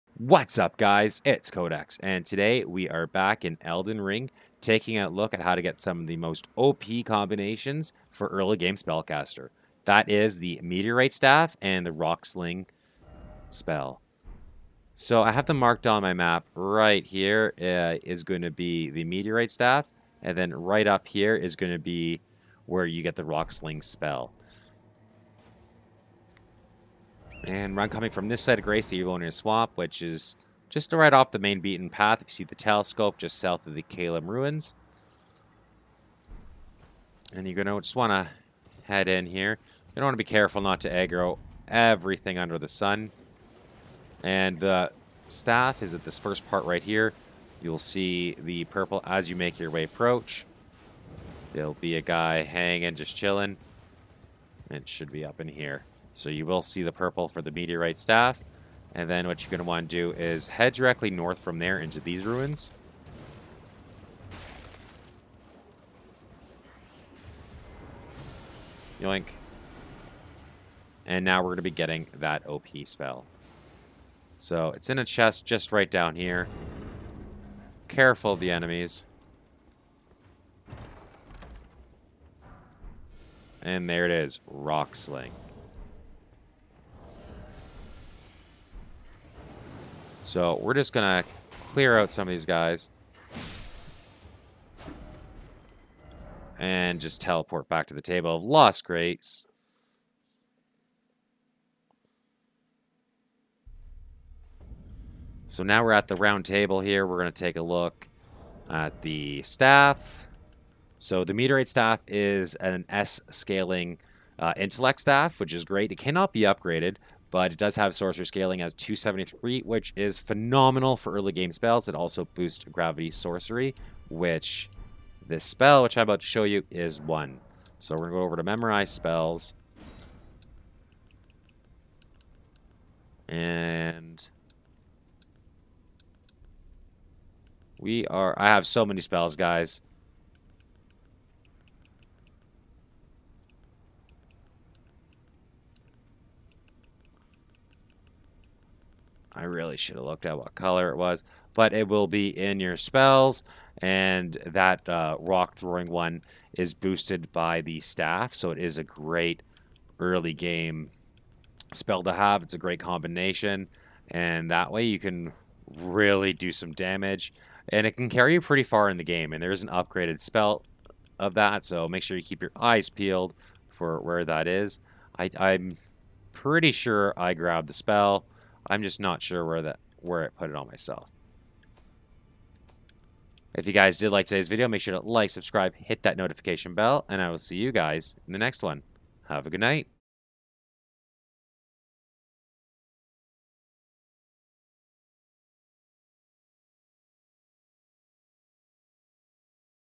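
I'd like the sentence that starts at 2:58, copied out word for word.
I'm just not sure where that where it put it on myself.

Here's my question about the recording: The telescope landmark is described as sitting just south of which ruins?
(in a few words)
Caelem Ruins.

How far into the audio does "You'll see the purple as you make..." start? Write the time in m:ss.
0:47.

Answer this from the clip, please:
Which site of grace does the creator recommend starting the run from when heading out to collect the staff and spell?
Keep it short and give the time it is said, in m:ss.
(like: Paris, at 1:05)
Evil Onion Swamp, at 0:28.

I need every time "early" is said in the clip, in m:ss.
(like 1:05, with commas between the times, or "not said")
0:08, 2:01, 2:39.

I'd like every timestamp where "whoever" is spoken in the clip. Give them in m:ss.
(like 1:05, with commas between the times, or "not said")
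not said.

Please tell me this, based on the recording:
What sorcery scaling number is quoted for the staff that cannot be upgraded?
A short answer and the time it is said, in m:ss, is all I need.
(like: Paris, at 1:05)
273, at 1:58.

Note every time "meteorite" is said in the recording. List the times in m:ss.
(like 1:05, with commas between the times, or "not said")
0:10, 0:19, 0:57, 1:51.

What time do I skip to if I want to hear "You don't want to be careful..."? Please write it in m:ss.
0:39.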